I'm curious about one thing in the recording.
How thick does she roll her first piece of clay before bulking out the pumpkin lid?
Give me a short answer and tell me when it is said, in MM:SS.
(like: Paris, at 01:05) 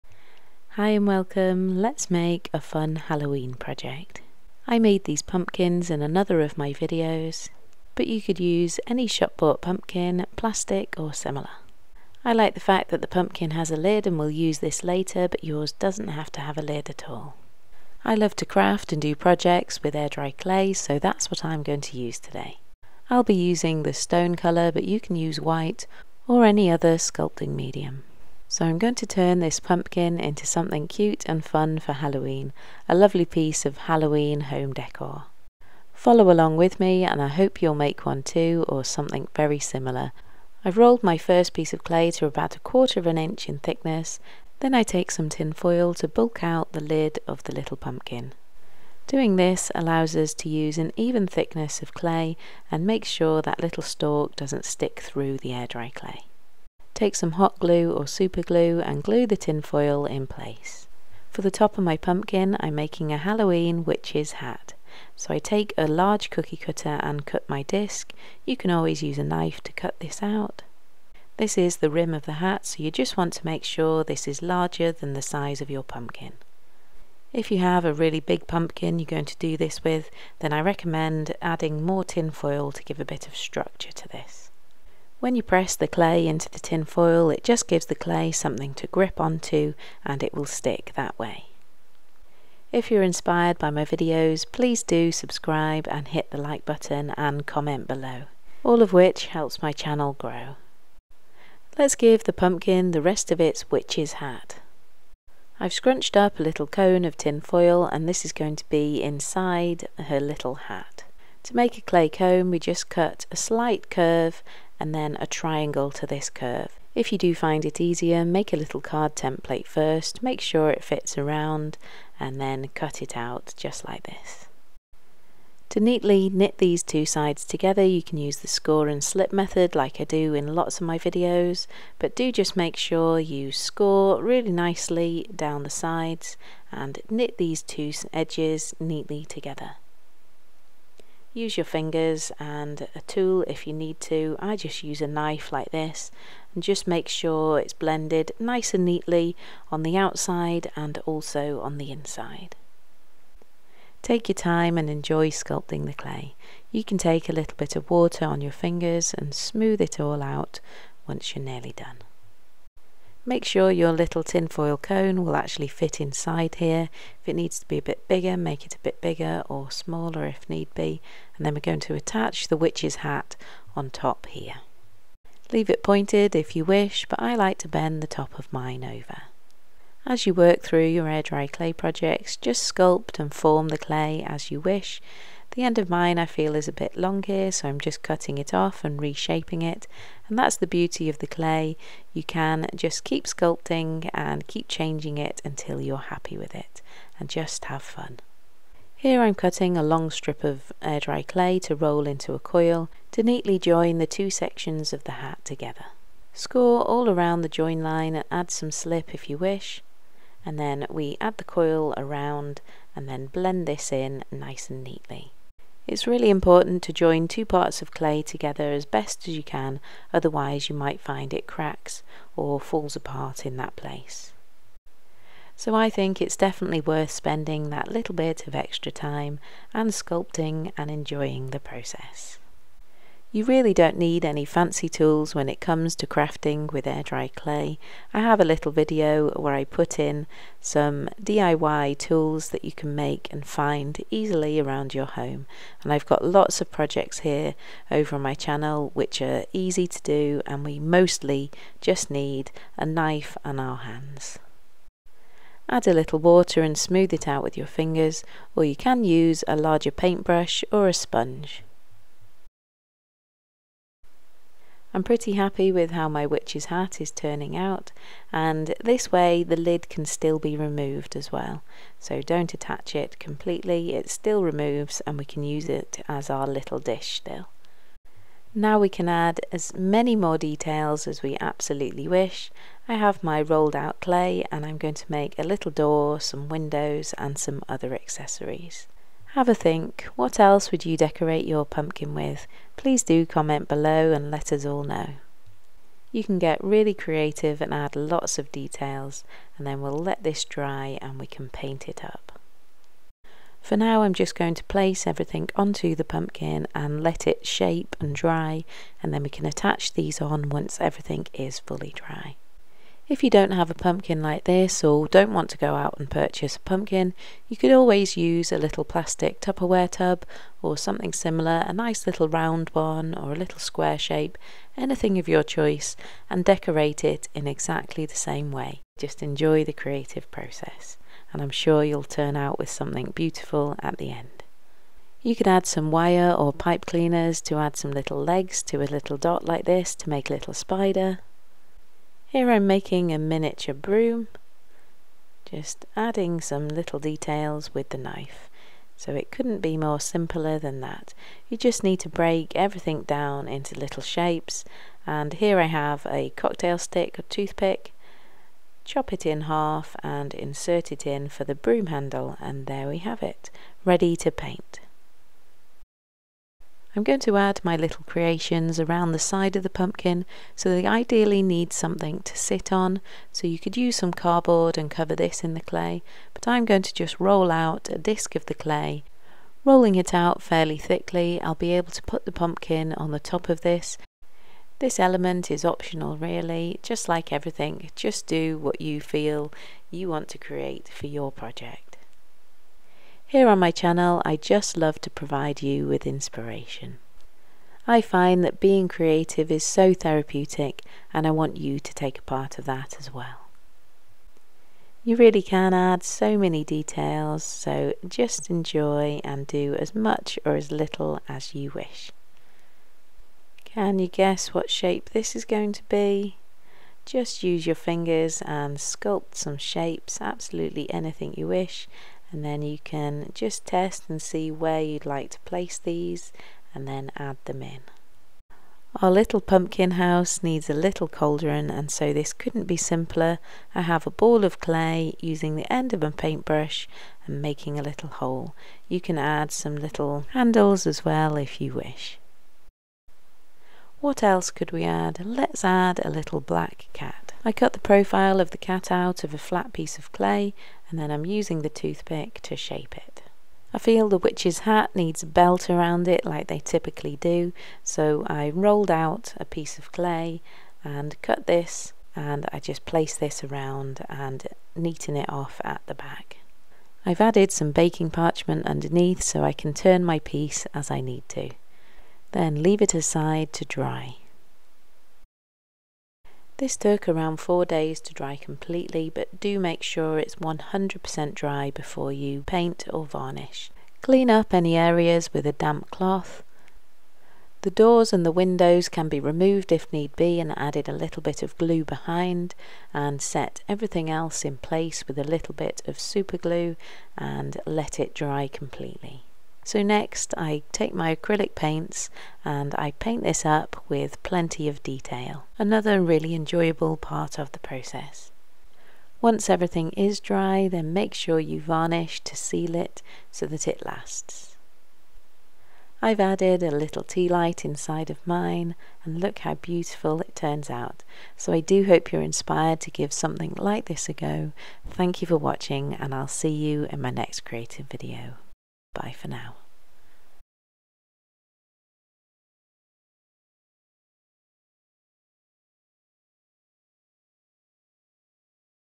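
a quarter of an inch, at 00:42.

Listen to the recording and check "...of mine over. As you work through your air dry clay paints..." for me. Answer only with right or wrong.
wrong.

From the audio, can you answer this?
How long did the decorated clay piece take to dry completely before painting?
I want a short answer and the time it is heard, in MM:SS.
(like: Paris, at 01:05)
4 days, at 07:57.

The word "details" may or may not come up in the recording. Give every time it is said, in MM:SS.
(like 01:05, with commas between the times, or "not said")
04:40, 04:58, 05:46, 06:46, 08:24.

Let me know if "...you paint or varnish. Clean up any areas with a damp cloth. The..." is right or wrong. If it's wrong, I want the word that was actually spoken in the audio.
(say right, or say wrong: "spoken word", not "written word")
right.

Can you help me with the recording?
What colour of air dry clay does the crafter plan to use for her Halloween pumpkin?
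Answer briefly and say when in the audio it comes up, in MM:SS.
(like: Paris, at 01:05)
stone, at 00:23.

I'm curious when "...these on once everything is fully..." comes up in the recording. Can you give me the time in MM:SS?
05:09.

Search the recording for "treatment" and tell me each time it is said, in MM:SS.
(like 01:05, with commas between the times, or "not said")
not said.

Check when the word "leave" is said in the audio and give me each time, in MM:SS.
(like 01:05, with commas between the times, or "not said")
02:55, 07:52.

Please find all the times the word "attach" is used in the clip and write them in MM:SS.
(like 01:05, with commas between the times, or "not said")
02:51, 04:32, 05:09.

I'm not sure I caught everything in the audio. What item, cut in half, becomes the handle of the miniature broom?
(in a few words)
cocktail stick.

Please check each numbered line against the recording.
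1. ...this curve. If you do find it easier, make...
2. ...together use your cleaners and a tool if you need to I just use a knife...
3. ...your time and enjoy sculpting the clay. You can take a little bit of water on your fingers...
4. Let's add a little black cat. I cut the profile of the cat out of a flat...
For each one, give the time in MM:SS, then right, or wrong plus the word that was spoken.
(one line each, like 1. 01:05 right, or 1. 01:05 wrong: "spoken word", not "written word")
1. 01:56 right
2. 02:19 wrong: "fingers", not "cleaners"
3. 02:34 right
4. 07:25 right.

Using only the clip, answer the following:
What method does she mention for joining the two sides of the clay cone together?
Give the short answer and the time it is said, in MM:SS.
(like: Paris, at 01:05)
score and slip, at 02:08.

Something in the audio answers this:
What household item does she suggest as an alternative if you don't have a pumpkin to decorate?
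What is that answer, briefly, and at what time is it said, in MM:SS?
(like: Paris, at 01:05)
Tupperware tub, at 05:19.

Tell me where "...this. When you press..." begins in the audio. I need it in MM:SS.
01:24.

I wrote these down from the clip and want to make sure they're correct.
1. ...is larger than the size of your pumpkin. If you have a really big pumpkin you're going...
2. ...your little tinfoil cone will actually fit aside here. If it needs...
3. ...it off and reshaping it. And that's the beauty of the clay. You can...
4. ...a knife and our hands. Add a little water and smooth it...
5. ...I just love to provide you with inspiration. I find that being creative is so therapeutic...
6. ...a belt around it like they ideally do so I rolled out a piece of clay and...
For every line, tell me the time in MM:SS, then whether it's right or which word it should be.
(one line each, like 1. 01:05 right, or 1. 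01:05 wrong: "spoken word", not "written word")
1. 01:14 right
2. 02:43 wrong: "inside", not "aside"
3. 03:08 right
4. 04:12 right
5. 06:34 right
6. 07:35 wrong: "typically", not "ideally".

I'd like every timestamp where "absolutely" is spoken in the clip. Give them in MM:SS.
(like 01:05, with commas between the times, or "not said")
04:41, 07:00.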